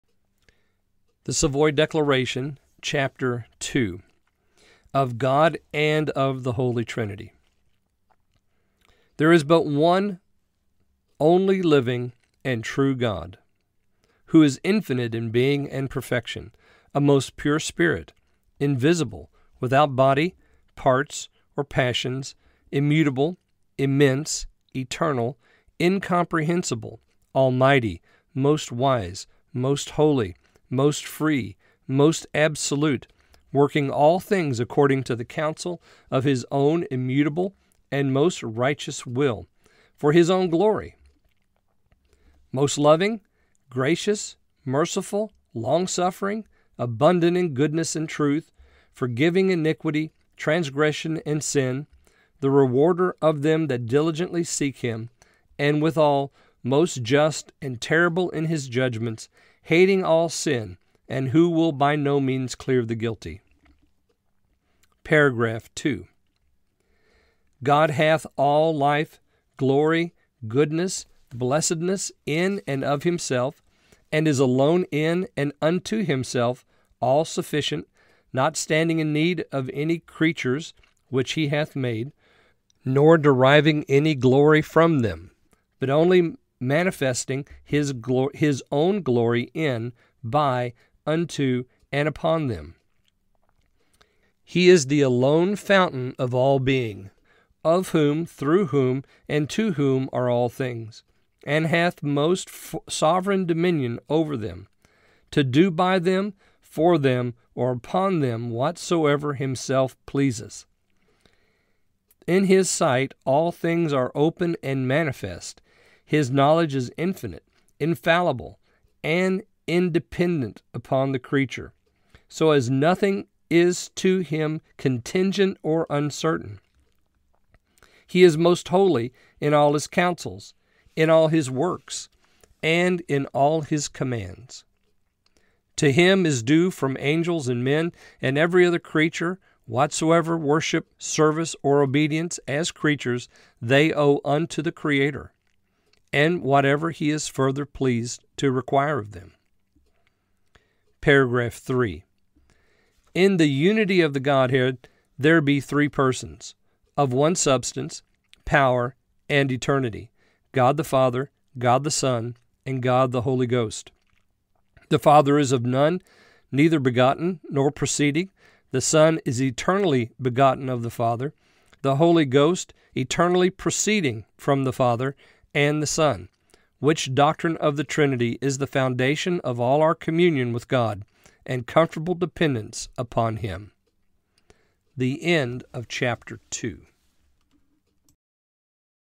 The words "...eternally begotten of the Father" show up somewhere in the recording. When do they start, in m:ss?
2:49.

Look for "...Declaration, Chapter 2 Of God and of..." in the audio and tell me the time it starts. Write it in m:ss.
0:01.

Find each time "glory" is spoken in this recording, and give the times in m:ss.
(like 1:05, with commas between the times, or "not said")
0:40, 1:09, 1:24, 1:29.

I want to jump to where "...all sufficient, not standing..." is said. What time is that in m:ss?
1:16.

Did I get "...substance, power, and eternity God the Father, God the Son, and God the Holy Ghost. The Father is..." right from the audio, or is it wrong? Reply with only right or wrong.
right.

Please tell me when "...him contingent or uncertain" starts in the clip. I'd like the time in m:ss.
2:04.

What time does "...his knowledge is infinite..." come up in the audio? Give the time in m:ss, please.
1:56.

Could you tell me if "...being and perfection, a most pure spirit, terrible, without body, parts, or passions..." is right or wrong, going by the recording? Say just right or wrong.
wrong.